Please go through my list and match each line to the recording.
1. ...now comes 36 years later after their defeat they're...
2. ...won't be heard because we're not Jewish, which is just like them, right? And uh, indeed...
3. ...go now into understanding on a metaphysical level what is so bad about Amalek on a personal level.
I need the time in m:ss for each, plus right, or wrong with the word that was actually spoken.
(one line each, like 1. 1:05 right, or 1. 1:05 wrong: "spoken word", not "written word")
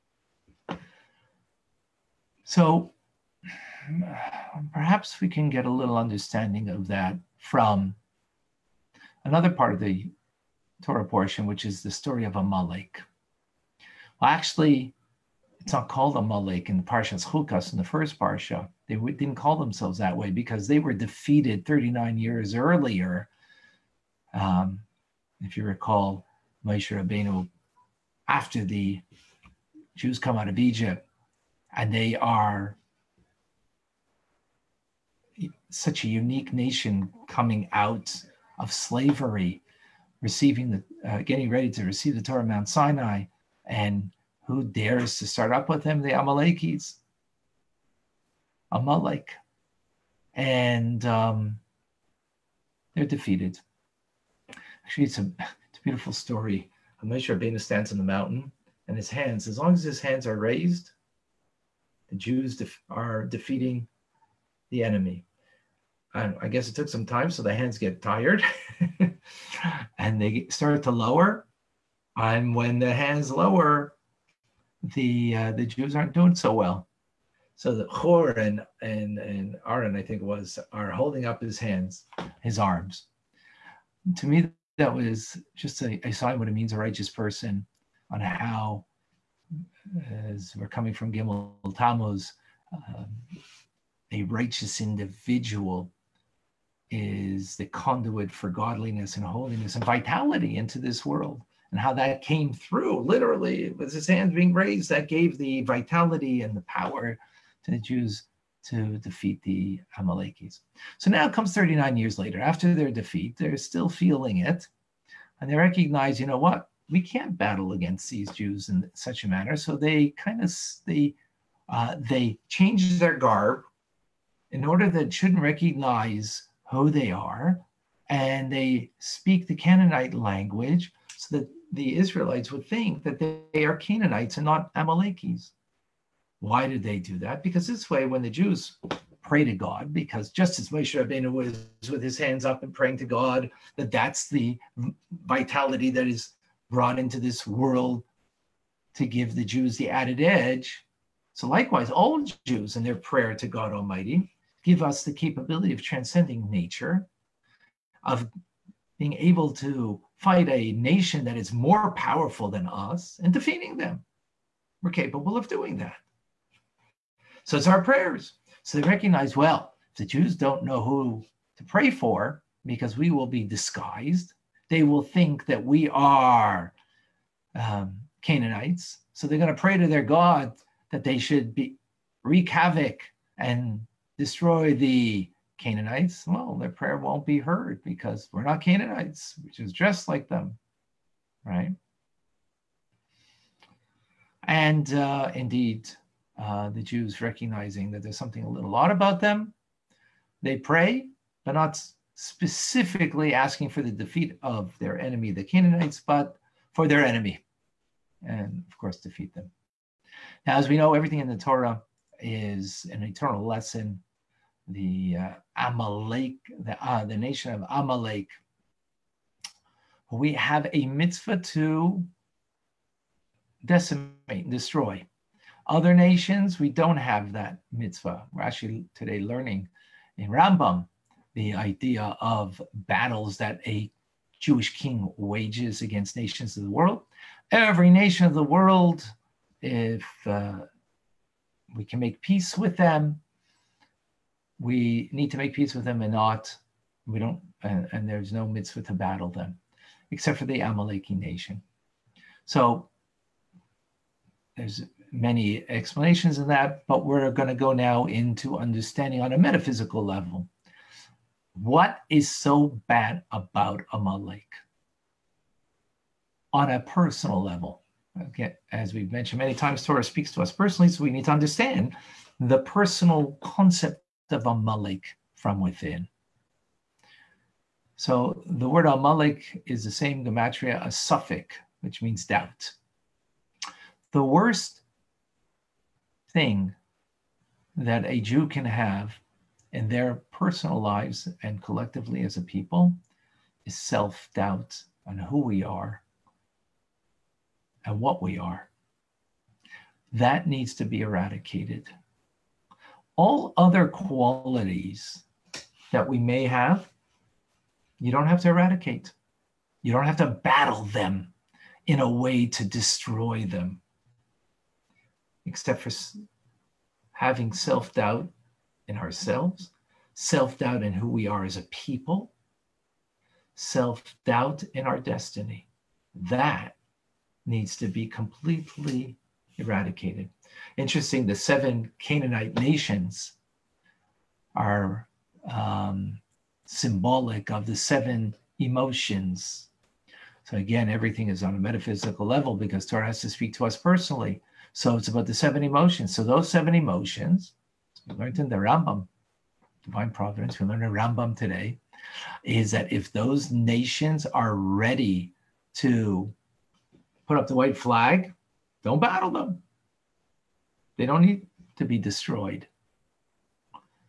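1. 1:51 wrong: "39", not "36"
2. 3:06 wrong: "Canaanites", not "Jewish"
3. 4:17 right.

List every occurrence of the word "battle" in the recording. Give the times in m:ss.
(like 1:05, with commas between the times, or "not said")
1:57, 3:52, 4:08, 5:10, 5:59.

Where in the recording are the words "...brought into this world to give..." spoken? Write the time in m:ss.
2:26.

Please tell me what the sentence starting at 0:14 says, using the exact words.
Well, actually, it's not called Amalek in the Parshas Chukas in the first Parsha.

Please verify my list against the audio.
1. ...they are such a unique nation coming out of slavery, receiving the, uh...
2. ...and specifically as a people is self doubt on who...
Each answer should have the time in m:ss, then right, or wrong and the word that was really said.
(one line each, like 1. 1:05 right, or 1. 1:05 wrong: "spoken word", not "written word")
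1. 0:31 right
2. 4:51 wrong: "collectively", not "specifically".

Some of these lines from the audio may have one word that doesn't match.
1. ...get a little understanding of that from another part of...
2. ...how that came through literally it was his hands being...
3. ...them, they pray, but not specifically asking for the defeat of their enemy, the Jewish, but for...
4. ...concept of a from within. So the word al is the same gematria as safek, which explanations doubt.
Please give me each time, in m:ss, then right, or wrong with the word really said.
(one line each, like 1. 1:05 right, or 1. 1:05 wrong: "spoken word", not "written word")
1. 0:05 right
2. 1:41 right
3. 3:19 wrong: "Canaanites", not "Jewish"
4. 4:33 wrong: "means", not "explanations".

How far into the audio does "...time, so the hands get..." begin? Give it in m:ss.
1:07.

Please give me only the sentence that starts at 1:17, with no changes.
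So the Chur and, and, and Aaron, I think was, are holding up his hands, his arms.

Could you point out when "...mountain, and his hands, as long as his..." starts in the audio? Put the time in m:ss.
0:58.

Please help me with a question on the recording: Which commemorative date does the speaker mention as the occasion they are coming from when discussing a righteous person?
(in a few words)
Gimel Tammuz.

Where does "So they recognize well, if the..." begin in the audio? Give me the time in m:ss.
2:48.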